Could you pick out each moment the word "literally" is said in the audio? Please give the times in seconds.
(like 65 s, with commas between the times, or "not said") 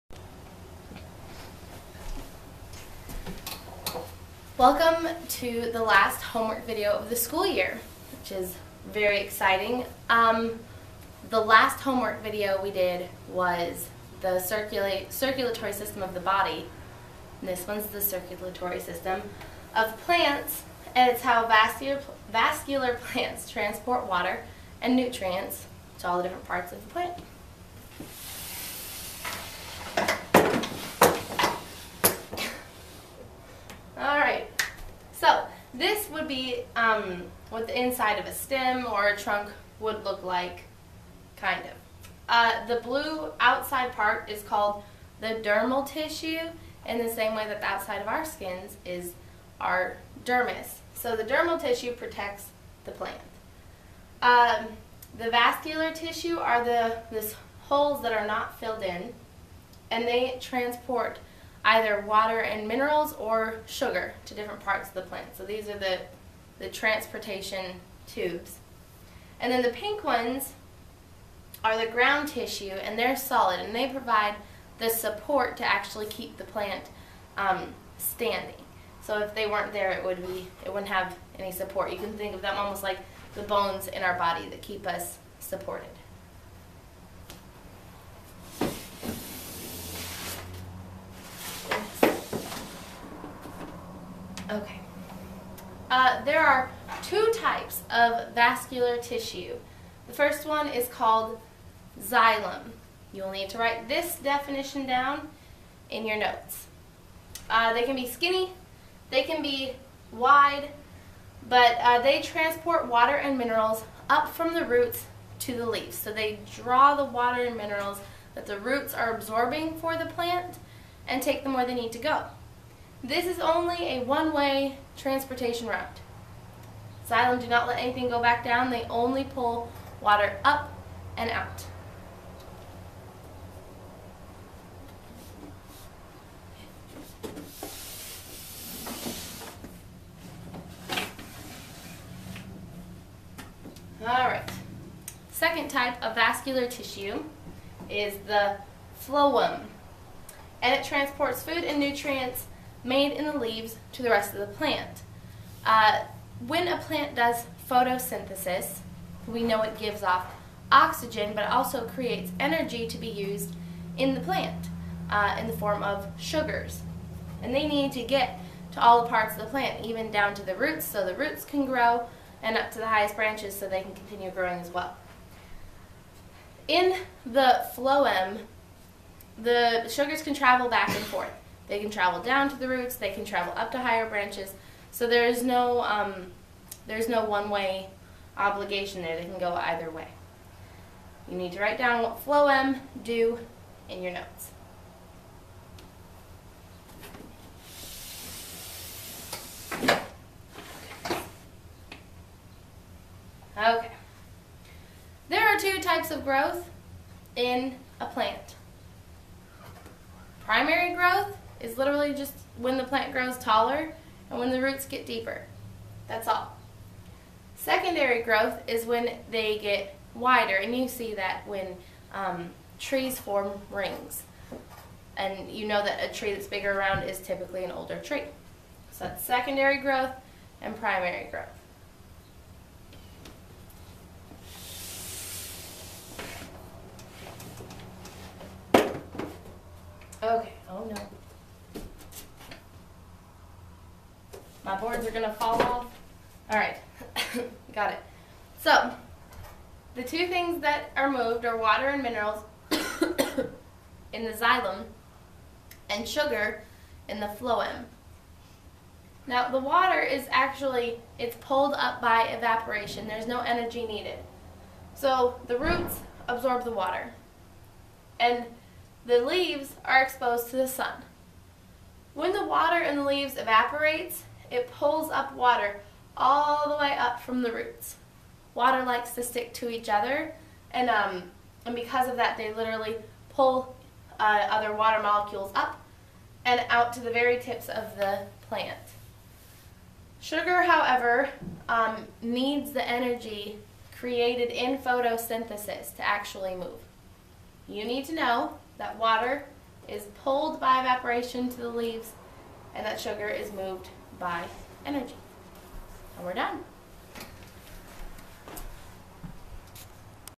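211 s, 282 s.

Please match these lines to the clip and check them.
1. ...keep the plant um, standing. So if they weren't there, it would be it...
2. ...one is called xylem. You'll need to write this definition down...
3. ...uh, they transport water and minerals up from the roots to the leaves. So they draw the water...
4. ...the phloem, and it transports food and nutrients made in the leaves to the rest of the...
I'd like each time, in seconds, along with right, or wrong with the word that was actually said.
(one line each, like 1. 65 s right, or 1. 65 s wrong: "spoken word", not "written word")
1. 76 s right
2. 100 s right
3. 111 s right
4. 148 s right.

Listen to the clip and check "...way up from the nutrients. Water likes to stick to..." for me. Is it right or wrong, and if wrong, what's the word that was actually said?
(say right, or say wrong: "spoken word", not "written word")
wrong: "roots", not "nutrients".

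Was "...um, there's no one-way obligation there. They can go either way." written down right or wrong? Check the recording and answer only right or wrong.
right.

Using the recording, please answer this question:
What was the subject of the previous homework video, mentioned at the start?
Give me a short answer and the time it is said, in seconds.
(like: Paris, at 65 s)
Circulatory system of the body, at 15 s.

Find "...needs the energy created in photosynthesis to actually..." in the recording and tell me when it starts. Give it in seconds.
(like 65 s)
292 s.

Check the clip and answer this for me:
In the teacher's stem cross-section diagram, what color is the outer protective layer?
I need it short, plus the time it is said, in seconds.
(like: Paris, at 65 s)
Blue, at 42 s.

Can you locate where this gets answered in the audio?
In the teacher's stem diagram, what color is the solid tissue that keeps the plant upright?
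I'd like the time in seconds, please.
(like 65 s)
69 s.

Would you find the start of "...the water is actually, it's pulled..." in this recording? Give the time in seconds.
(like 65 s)
259 s.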